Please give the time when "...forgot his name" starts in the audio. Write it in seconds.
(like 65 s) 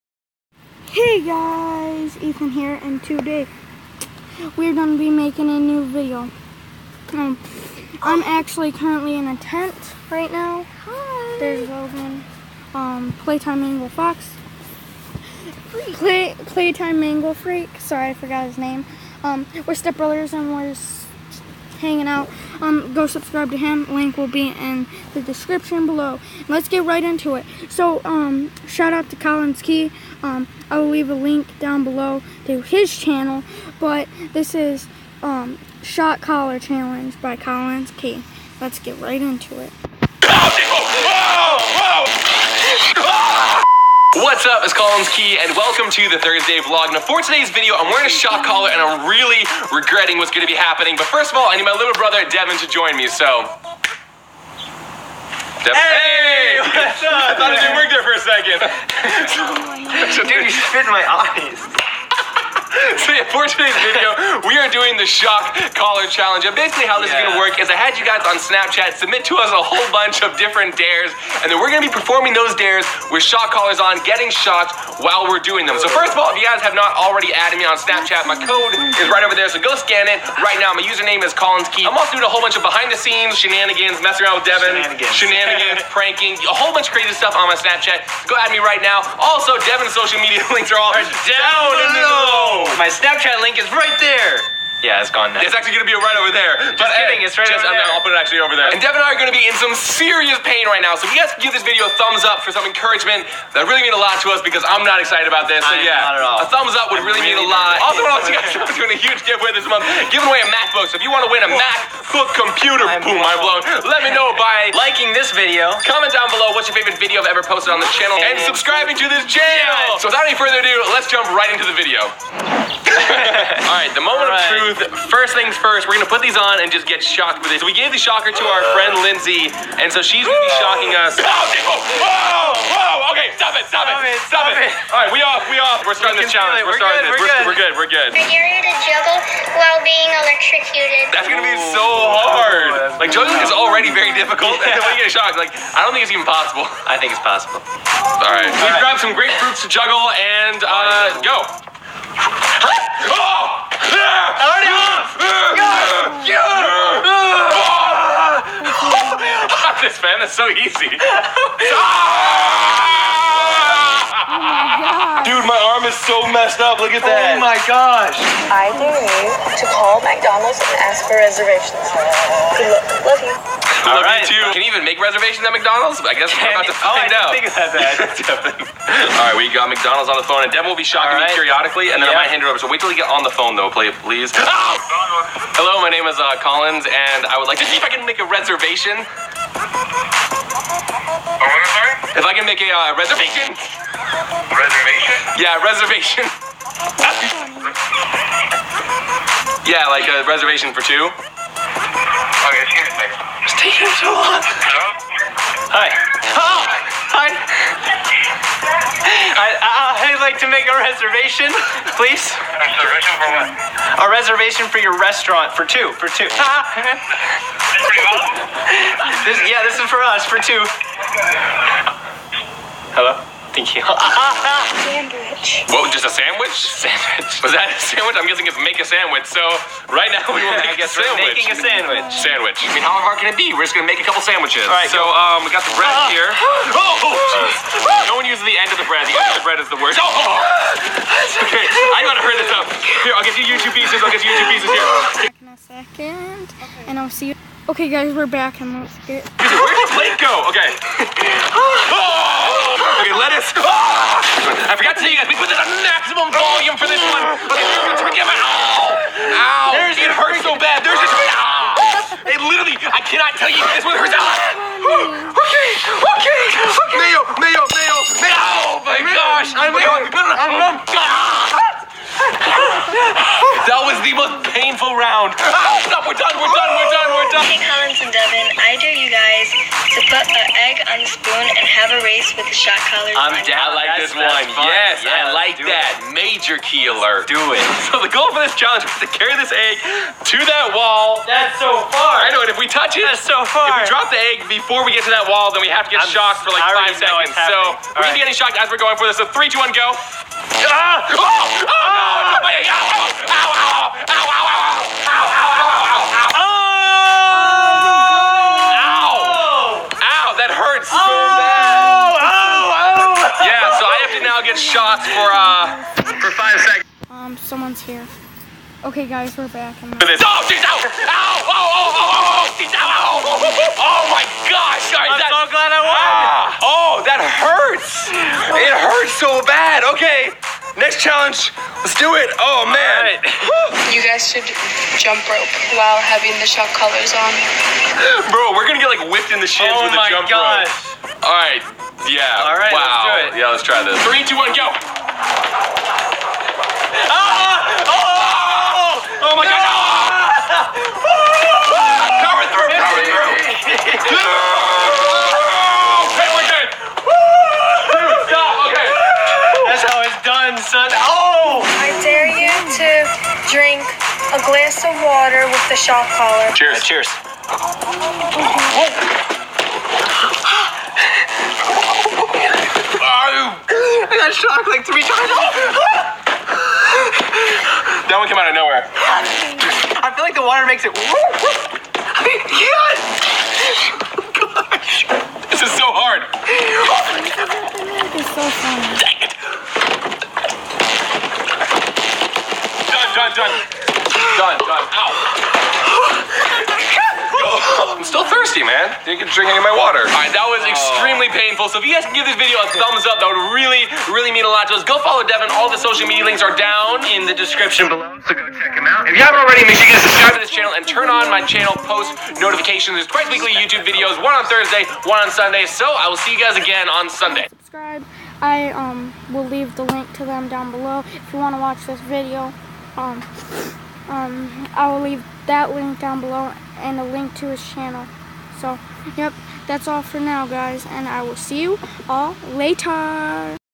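18 s.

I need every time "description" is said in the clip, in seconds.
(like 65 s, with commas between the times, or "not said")
25 s, 407 s.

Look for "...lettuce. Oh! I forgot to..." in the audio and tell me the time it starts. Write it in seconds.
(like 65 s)
253 s.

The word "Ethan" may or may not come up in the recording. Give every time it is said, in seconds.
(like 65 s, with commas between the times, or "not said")
2 s.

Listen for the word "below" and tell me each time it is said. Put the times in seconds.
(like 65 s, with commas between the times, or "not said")
25 s, 31 s, 91 s, 116 s, 407 s, 420 s, 426 s.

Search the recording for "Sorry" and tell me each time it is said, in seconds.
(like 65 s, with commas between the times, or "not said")
17 s, 324 s.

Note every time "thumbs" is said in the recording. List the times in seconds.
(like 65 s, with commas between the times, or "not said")
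102 s, 106 s, 402 s.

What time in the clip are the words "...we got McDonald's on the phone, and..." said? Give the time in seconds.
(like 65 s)
179 s.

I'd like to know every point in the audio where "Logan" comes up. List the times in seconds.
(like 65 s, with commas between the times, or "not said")
11 s.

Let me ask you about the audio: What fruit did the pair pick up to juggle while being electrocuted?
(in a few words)
Grapefruits.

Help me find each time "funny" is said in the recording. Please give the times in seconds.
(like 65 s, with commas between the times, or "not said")
388 s.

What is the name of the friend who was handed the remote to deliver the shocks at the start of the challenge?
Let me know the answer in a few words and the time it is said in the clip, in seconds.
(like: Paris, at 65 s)
Lindsay, at 129 s.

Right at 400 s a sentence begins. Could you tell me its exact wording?
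All right, that was extremely oh.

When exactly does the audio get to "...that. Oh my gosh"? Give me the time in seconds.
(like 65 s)
167 s.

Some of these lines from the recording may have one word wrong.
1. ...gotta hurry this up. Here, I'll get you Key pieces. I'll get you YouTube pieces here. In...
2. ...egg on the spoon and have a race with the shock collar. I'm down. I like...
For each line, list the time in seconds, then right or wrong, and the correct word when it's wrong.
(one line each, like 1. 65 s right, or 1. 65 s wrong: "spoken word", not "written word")
1. 242 s wrong: "YouTube", not "Key"
2. 280 s right.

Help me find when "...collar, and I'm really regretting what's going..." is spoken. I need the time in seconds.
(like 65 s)
48 s.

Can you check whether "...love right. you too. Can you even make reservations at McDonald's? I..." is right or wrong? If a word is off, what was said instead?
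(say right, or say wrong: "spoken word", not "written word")
right.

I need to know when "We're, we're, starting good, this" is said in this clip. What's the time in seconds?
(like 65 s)
136 s.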